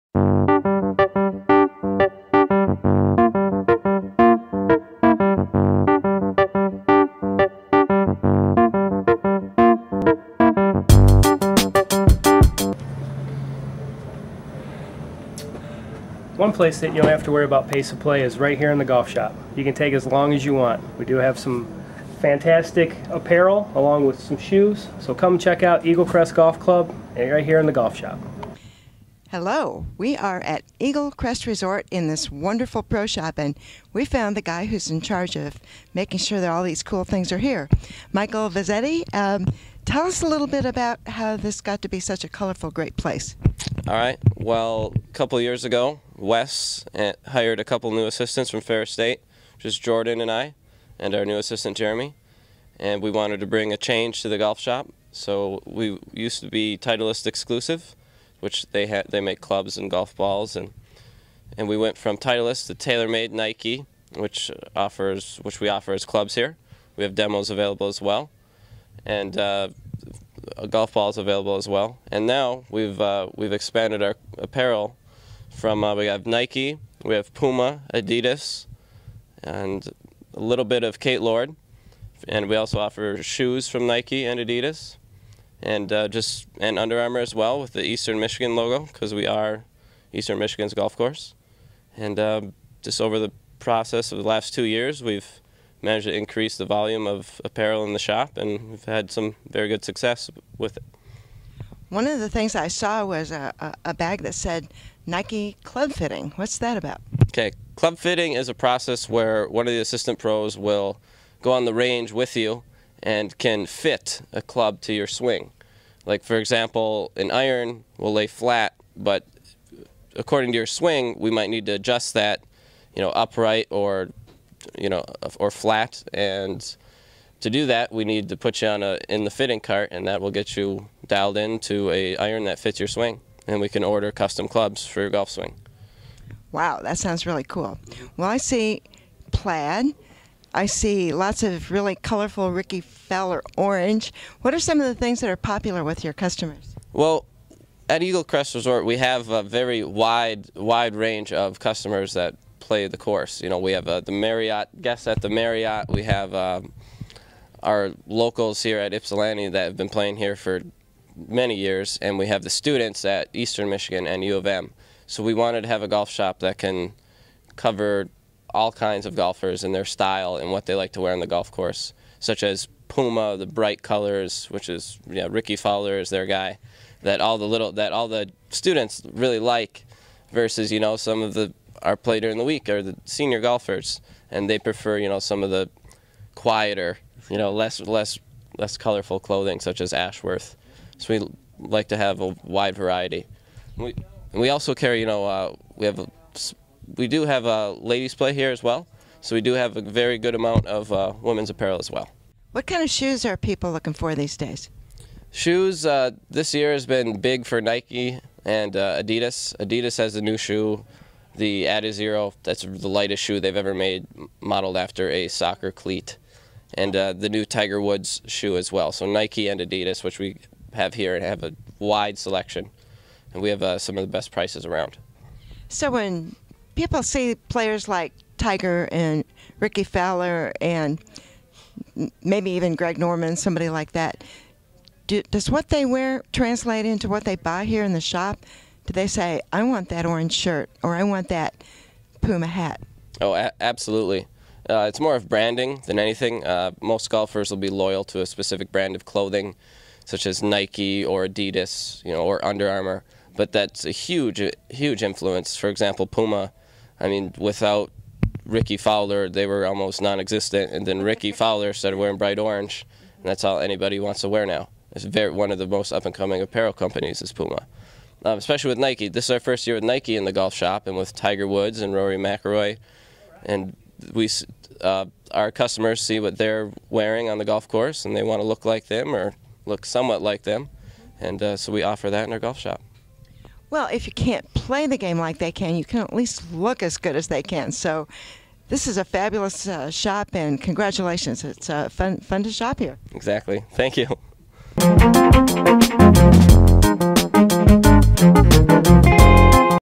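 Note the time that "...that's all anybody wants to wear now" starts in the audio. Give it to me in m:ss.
4:23.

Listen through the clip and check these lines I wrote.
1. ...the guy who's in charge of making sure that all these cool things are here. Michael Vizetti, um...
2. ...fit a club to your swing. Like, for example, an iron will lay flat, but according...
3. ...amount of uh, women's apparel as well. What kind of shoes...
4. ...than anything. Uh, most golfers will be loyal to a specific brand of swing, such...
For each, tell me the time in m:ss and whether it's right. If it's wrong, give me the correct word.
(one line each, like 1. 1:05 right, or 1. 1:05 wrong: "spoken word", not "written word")
1. 0:34 right
2. 1:53 right
3. 3:20 right
4. 4:05 wrong: "clothing", not "swing".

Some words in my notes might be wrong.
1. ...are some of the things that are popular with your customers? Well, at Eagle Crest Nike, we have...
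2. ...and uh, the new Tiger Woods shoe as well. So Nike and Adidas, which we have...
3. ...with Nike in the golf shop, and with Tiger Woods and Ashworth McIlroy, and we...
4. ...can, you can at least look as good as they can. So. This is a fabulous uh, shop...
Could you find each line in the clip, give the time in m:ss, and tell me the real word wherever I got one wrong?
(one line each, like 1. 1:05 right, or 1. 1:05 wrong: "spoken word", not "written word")
1. 2:24 wrong: "Resort", not "Nike"
2. 3:36 right
3. 4:29 wrong: "Rory", not "Ashworth"
4. 4:45 right.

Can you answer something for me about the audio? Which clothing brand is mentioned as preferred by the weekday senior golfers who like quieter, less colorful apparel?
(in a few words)
Ashworth.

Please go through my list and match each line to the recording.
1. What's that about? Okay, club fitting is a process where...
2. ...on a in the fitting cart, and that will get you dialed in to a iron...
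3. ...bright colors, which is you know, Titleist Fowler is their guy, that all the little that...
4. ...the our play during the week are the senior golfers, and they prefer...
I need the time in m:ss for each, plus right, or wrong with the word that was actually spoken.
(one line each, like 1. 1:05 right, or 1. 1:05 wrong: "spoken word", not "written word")
1. 1:46 right
2. 2:08 right
3. 2:53 wrong: "Rickie", not "Titleist"
4. 3:01 right.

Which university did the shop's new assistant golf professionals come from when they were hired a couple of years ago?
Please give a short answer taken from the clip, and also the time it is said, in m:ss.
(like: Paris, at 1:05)
Ferris State, at 0:48.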